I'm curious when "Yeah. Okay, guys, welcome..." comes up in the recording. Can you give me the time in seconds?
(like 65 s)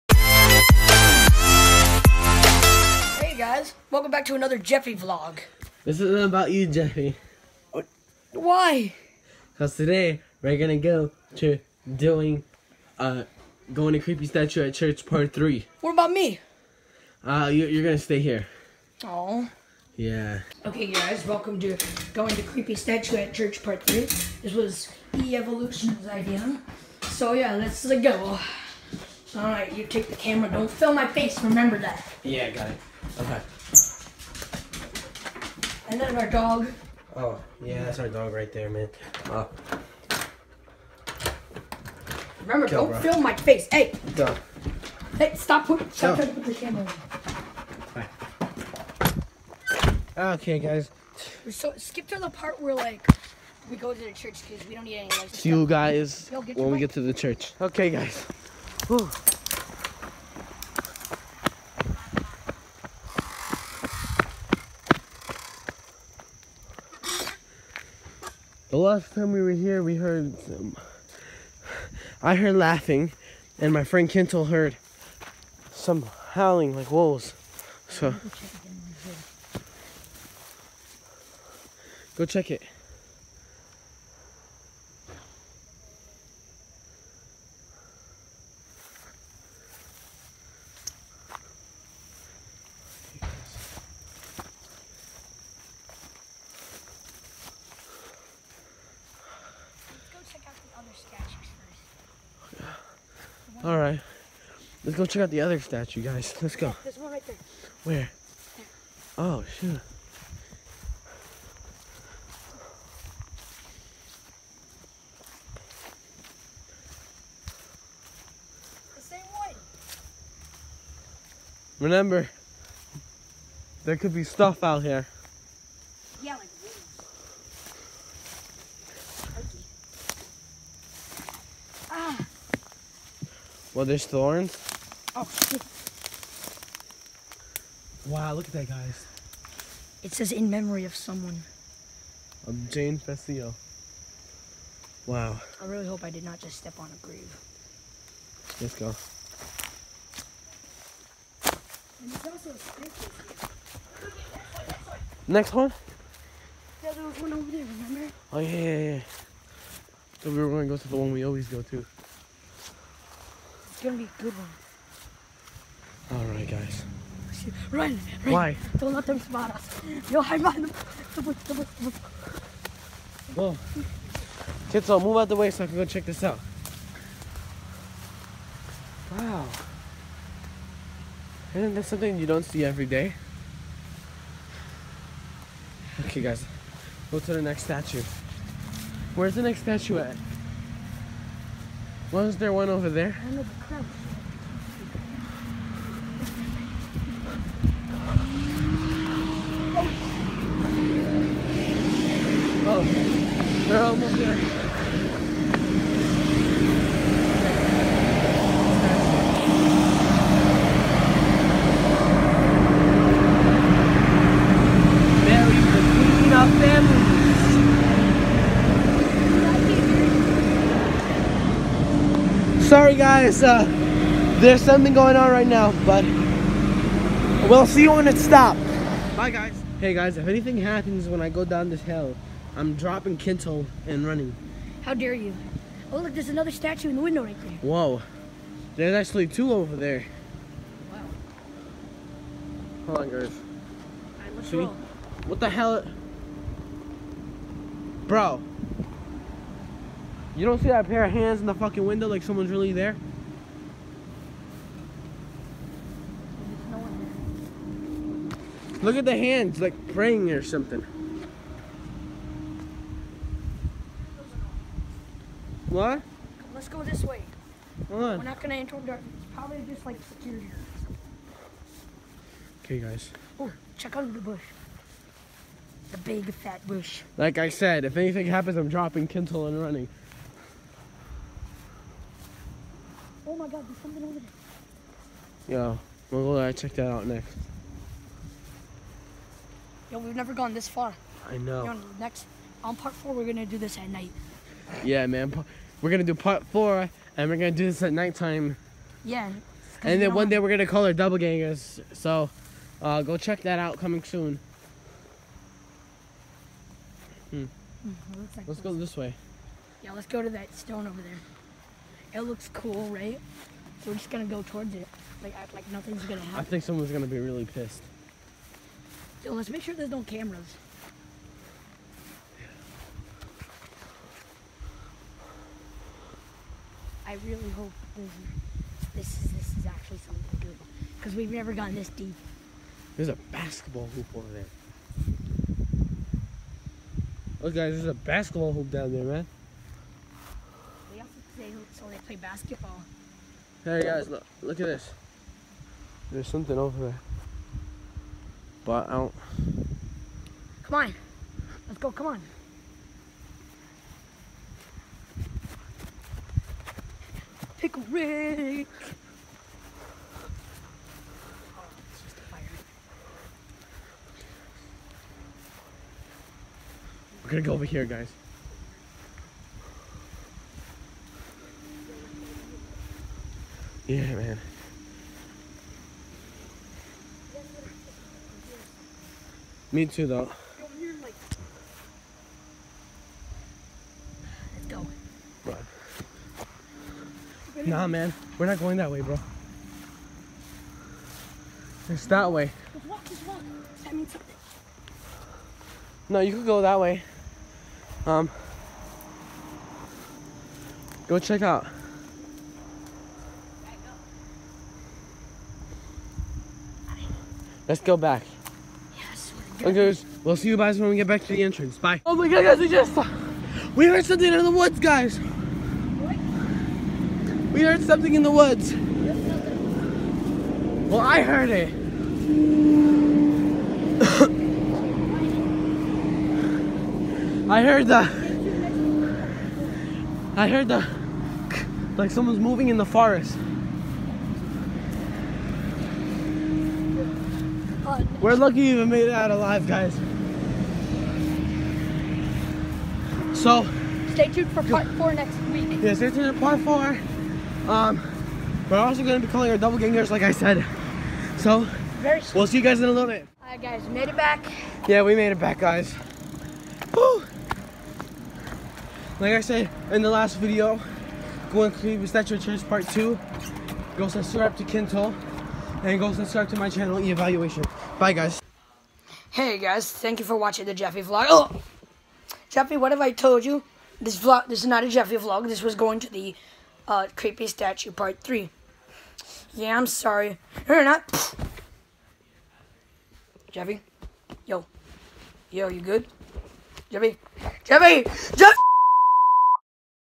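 19 s.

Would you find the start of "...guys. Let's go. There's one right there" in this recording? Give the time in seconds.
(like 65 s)
106 s.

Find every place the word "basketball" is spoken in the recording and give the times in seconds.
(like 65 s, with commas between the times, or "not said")
333 s, 337 s, 342 s.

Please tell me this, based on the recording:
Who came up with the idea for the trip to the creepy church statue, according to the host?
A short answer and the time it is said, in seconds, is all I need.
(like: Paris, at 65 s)
E-Evolution, at 25 s.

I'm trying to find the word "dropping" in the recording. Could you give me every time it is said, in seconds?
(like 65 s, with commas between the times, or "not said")
232 s, 278 s.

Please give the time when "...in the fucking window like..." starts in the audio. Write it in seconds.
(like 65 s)
251 s.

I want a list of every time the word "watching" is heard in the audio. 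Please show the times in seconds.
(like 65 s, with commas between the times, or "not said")
470 s.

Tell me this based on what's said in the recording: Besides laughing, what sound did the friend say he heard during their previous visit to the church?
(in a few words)
Howling like wolves.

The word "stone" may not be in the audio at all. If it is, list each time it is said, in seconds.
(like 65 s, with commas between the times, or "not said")
310 s.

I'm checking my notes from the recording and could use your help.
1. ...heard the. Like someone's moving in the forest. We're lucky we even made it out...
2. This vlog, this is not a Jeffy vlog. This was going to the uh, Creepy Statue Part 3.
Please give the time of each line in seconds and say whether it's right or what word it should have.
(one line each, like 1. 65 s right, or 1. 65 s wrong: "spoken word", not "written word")
1. 430 s right
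2. 474 s right.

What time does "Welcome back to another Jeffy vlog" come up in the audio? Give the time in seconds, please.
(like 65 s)
3 s.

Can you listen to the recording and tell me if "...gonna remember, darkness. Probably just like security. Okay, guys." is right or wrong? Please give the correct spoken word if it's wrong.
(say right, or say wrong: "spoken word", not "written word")
wrong: "enter", not "remember".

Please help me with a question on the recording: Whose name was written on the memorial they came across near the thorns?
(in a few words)
Jane Fessio.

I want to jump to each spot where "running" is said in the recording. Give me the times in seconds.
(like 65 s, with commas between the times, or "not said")
234 s, 279 s.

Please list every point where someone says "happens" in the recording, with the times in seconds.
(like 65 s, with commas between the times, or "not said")
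230 s, 278 s, 316 s.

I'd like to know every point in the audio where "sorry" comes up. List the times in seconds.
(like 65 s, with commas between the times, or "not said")
222 s, 479 s.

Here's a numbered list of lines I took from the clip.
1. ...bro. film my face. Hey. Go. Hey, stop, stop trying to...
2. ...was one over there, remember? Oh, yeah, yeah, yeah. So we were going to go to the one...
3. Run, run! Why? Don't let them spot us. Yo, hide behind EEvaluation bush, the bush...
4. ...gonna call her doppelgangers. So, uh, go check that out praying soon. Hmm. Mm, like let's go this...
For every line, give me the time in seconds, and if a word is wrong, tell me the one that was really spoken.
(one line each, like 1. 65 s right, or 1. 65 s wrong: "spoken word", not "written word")
1. 42 s right
2. 157 s right
3. 167 s wrong: "The", not "EEvaluation"
4. 300 s wrong: "coming", not "praying".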